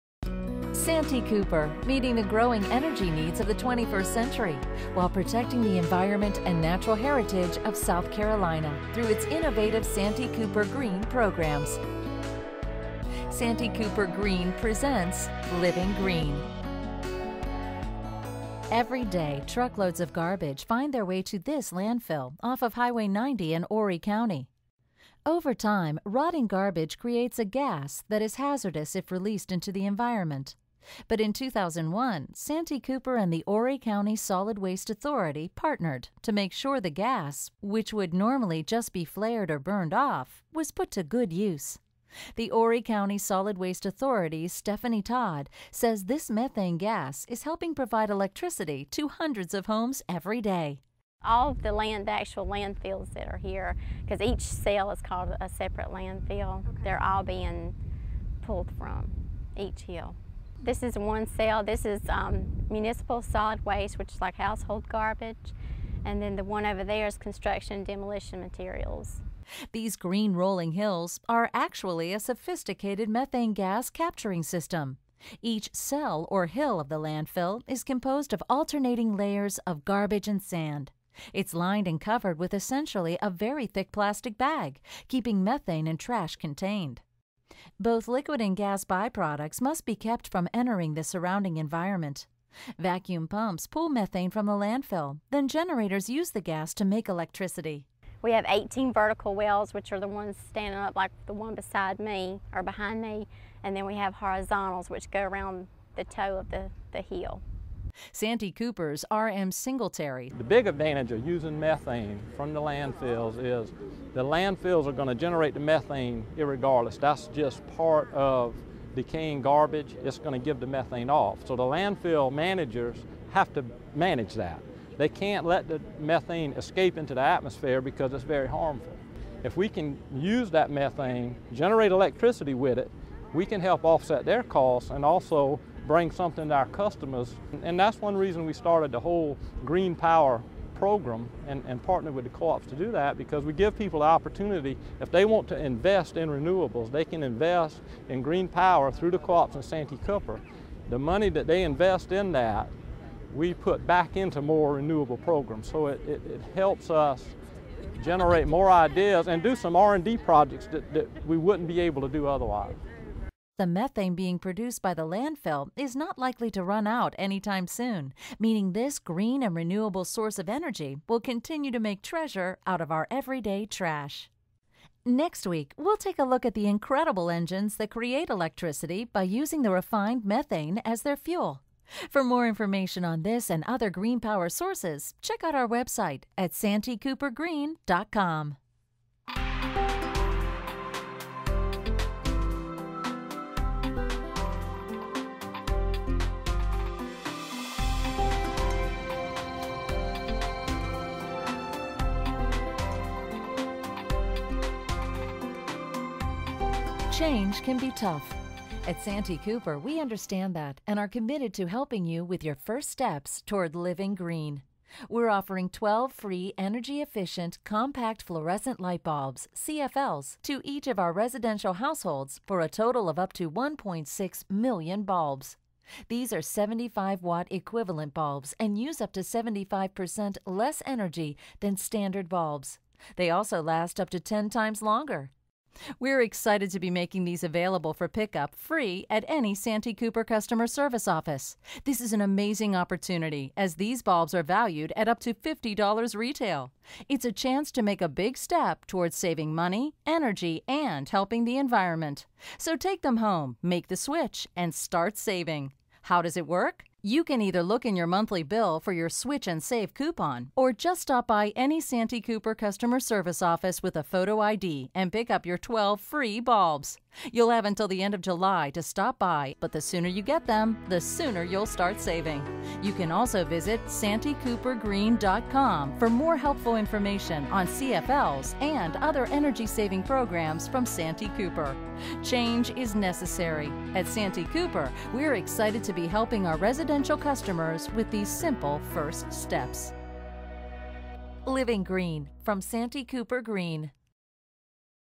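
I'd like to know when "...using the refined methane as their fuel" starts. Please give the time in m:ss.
2:59.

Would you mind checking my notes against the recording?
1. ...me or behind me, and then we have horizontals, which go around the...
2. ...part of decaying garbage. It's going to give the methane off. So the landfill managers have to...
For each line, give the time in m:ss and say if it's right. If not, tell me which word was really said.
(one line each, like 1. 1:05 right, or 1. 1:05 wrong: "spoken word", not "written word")
1. 1:41 right
2. 1:57 right.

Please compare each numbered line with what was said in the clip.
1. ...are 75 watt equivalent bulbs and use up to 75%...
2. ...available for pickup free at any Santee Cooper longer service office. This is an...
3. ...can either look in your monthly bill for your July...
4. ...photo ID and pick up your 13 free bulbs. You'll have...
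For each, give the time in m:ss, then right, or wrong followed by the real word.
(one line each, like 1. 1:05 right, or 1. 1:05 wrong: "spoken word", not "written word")
1. 3:46 right
2. 3:57 wrong: "customer", not "longer"
3. 4:17 wrong: "Switch", not "July"
4. 4:24 wrong: "12", not "13".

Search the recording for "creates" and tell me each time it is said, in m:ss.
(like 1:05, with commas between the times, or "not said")
0:26, 2:57.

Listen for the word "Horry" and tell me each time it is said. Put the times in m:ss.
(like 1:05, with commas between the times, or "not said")
0:23, 0:33, 0:42.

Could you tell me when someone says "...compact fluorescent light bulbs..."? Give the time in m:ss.
3:37.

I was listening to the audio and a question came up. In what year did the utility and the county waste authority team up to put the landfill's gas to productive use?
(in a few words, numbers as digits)
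2001.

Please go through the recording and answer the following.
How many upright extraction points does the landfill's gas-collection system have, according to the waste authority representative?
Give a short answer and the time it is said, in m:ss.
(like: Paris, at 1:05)
18, at 1:38.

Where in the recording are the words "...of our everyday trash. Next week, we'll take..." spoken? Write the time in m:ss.
2:52.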